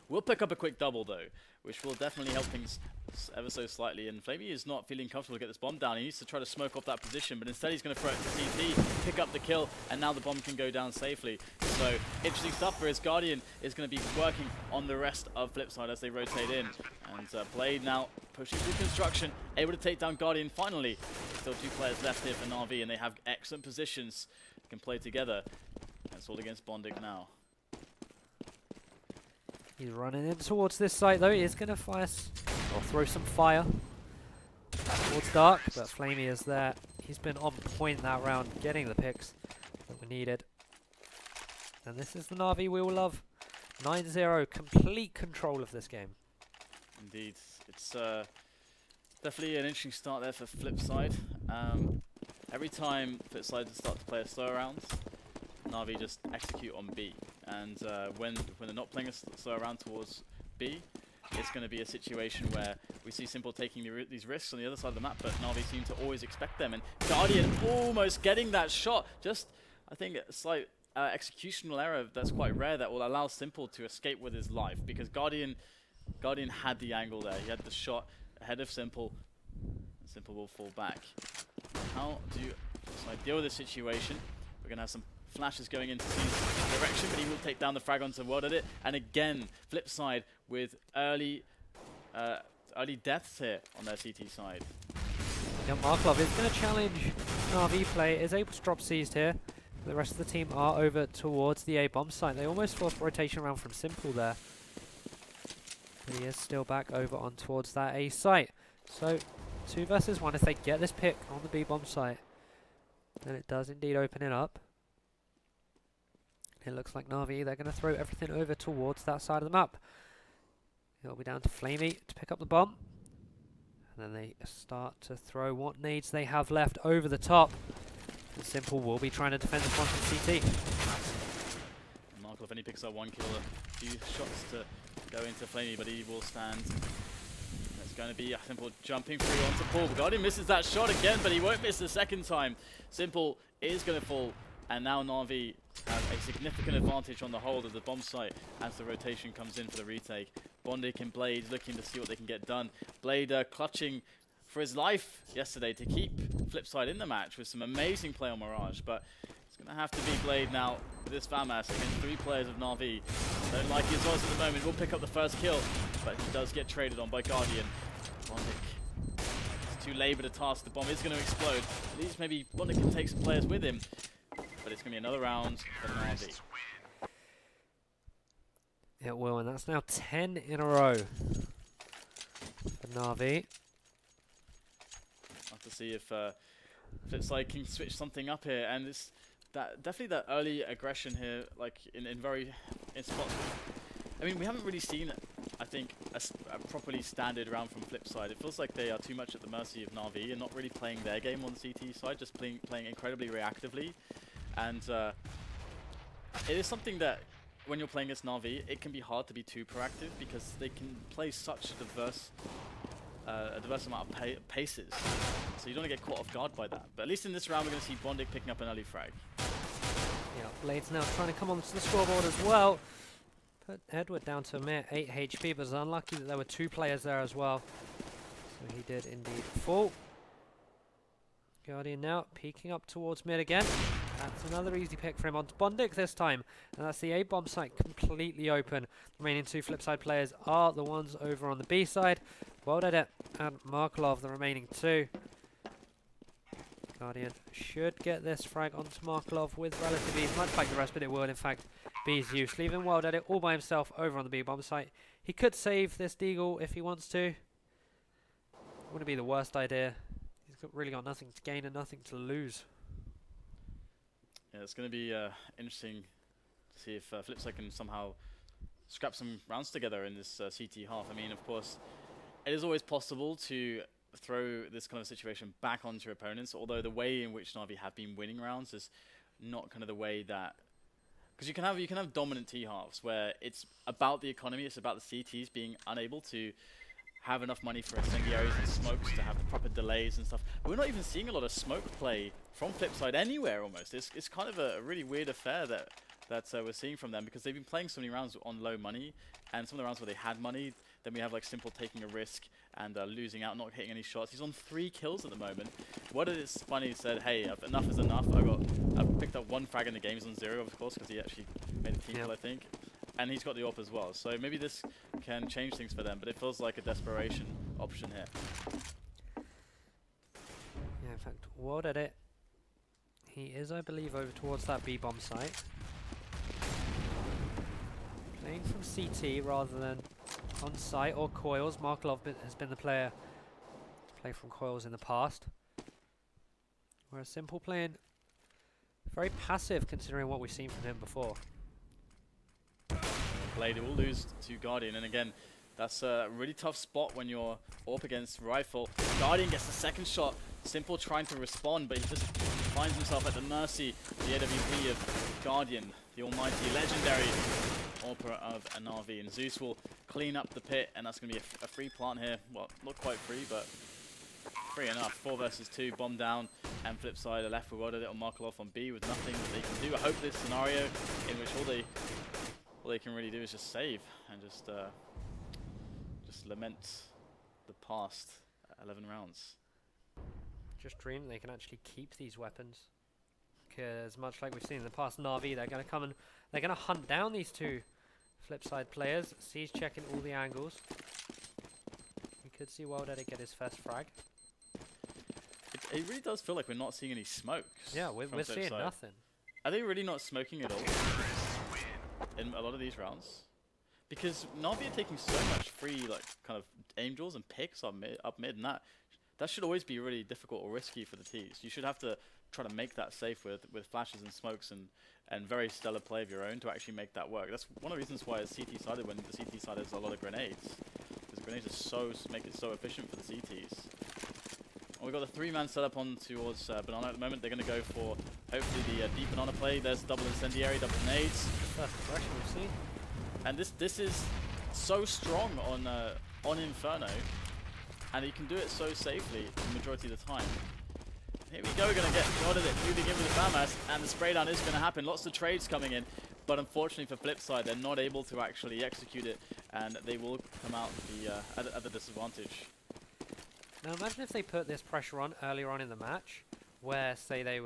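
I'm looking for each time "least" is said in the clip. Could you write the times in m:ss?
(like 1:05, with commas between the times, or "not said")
2:52, 3:37.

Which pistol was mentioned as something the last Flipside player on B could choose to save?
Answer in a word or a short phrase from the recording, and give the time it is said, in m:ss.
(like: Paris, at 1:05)
Deagle, at 4:16.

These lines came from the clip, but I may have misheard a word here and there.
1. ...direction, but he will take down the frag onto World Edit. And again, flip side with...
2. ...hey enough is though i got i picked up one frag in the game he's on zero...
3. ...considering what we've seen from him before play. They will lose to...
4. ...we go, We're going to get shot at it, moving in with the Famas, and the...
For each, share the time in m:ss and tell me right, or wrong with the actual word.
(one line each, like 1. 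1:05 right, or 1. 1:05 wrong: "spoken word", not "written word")
1. 1:26 right
2. 5:07 wrong: "enough", not "though"
3. 5:39 right
4. 7:21 right.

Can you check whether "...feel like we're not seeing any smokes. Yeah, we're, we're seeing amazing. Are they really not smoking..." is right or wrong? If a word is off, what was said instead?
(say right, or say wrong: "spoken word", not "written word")
wrong: "nothing", not "amazing".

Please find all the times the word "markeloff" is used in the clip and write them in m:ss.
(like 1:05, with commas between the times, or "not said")
1:35, 2:12, 4:03, 4:09, 5:31, 6:08.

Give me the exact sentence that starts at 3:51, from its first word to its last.
Guardian now peeking up towards mid again.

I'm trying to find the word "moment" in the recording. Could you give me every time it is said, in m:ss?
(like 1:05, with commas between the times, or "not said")
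2:44, 5:05, 7:07.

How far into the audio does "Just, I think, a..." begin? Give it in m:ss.
1:09.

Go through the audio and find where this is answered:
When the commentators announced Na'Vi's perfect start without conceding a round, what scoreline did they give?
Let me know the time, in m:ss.
0:43.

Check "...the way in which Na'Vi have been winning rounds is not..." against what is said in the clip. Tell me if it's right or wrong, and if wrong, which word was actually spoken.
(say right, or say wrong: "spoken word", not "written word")
right.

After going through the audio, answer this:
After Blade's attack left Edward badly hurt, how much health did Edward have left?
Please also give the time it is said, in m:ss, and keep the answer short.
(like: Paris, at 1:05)
8 HP, at 3:44.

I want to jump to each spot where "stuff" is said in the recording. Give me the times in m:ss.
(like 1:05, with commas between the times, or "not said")
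0:12, 4:50.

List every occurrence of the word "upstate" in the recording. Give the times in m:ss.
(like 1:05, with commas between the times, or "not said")
not said.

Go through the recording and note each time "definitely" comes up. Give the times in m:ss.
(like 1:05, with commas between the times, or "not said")
0:01, 0:49, 3:09.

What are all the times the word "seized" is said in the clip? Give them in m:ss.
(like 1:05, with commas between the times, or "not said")
1:26, 1:38, 6:29.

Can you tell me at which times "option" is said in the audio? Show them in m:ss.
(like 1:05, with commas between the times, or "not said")
5:17.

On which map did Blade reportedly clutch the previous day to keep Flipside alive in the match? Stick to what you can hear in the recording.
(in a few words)
Mirage.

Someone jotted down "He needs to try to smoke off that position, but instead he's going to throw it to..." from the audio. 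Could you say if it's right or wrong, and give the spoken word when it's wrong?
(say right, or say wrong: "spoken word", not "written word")
right.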